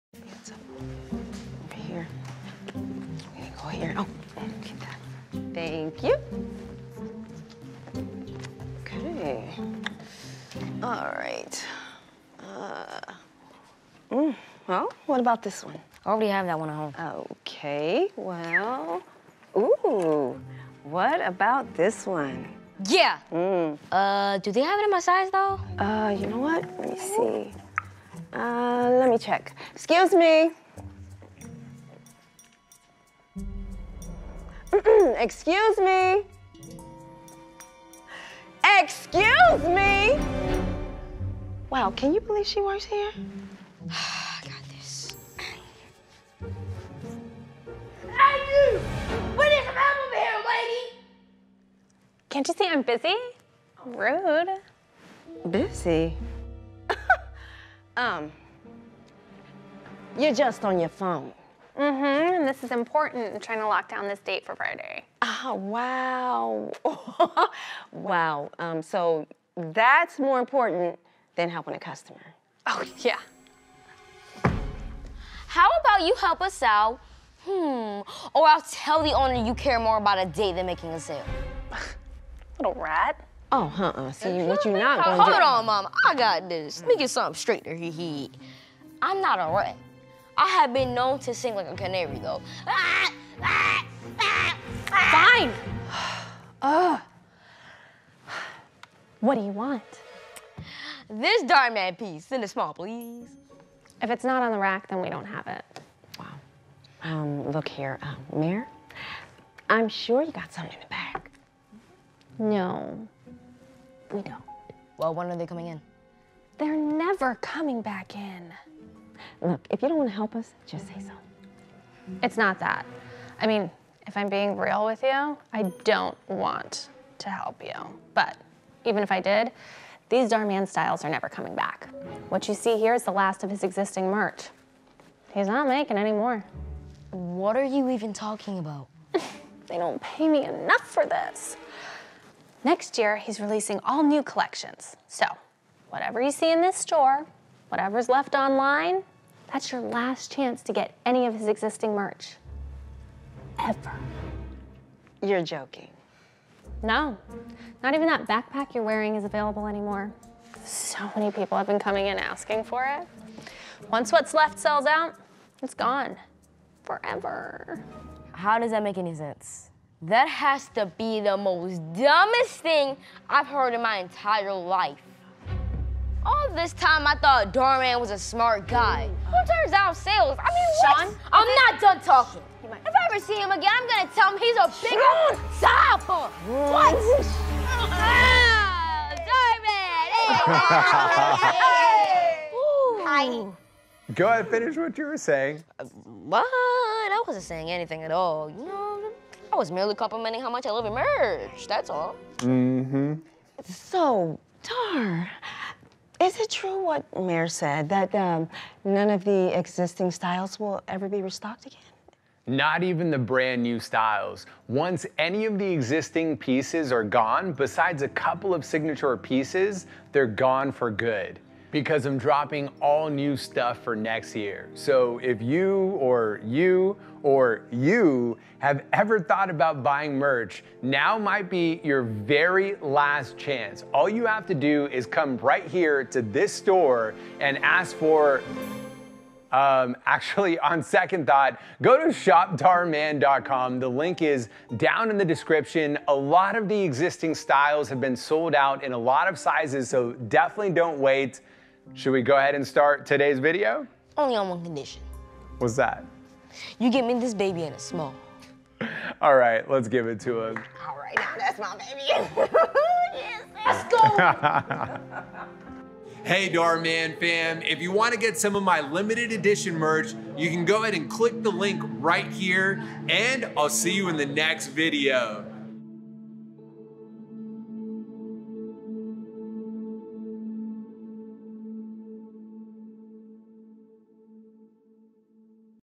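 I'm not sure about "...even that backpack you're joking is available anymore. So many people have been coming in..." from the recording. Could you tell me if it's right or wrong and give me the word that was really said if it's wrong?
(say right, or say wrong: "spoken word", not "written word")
wrong: "wearing", not "joking".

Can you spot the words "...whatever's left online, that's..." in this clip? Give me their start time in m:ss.
2:27.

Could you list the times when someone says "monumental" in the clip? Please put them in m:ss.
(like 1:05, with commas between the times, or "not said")
not said.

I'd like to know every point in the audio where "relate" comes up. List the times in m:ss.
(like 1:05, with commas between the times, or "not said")
not said.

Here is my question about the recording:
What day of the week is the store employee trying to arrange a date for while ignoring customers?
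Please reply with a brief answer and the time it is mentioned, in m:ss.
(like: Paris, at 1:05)
Friday, at 1:04.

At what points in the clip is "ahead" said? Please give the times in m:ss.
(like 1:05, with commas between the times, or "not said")
3:14, 4:12, 4:30.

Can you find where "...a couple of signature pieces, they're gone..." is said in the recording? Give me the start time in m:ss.
3:38.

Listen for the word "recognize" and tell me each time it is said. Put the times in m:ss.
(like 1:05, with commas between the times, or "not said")
not said.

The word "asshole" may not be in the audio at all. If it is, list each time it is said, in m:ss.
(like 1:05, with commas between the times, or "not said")
not said.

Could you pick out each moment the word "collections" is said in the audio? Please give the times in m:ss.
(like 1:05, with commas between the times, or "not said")
2:24.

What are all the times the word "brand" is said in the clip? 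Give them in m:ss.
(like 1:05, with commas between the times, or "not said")
3:33.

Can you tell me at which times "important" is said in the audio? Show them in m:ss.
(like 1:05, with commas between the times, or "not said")
1:02, 1:10.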